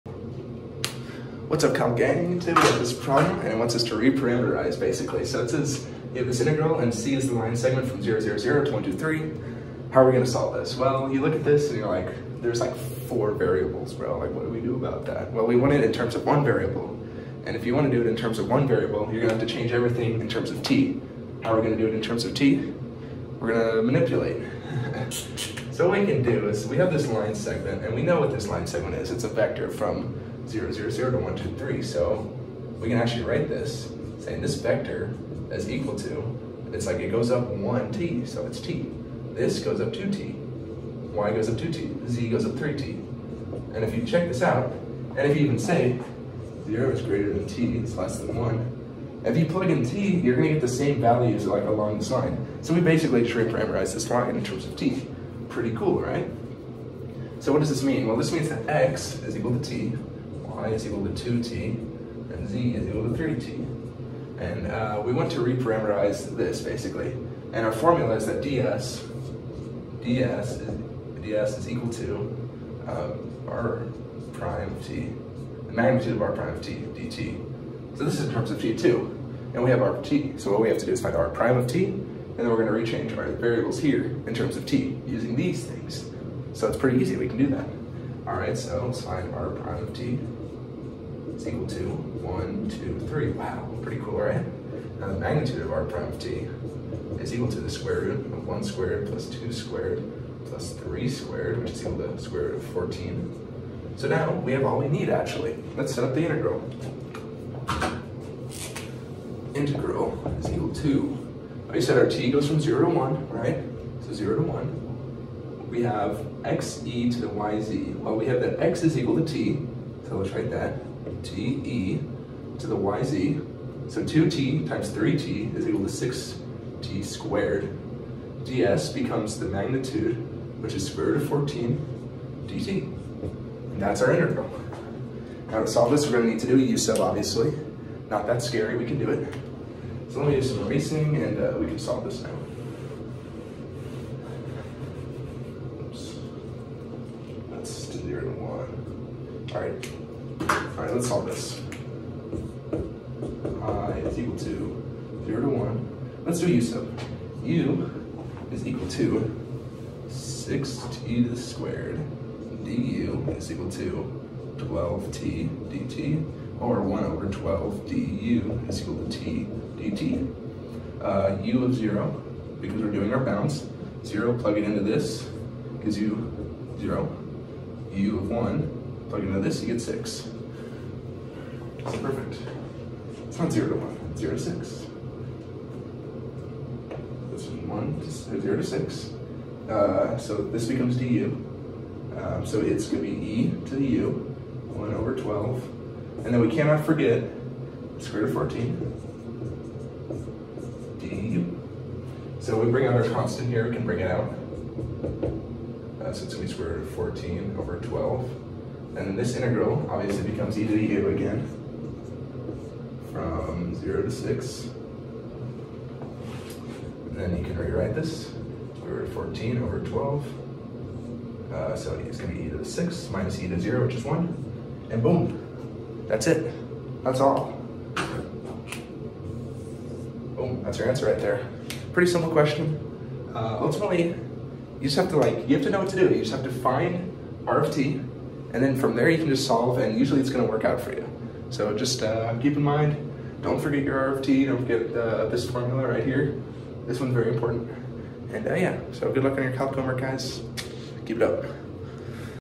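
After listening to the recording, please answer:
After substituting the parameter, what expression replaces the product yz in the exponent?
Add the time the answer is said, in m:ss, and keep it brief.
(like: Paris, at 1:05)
6t squared, at 2:05.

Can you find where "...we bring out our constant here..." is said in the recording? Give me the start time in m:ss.
3:22.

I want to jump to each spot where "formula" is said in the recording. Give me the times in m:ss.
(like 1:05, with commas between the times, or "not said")
1:07, 4:05.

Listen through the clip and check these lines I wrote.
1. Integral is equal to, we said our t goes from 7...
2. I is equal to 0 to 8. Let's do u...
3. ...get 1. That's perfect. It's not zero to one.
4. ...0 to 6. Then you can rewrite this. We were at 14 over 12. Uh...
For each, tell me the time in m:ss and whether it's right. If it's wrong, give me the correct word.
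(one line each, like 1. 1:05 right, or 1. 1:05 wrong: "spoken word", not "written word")
1. 1:49 wrong: "0", not "7"
2. 2:33 wrong: "1", not "8"
3. 2:59 wrong: "6", not "1"
4. 3:33 right.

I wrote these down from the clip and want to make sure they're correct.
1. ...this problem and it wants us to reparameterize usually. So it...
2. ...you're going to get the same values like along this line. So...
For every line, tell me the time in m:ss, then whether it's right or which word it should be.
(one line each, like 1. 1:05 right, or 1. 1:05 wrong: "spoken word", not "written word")
1. 0:02 wrong: "basically", not "usually"
2. 0:50 right.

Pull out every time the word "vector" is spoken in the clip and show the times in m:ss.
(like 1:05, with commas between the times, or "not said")
0:29, 0:34.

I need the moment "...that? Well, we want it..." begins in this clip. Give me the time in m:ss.
0:15.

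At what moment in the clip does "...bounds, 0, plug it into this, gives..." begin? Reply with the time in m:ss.
2:53.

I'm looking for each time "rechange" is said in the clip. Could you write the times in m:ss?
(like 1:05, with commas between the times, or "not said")
1:22.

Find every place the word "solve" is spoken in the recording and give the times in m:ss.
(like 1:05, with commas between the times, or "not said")
0:10, 2:15, 2:21, 2:31, 3:59.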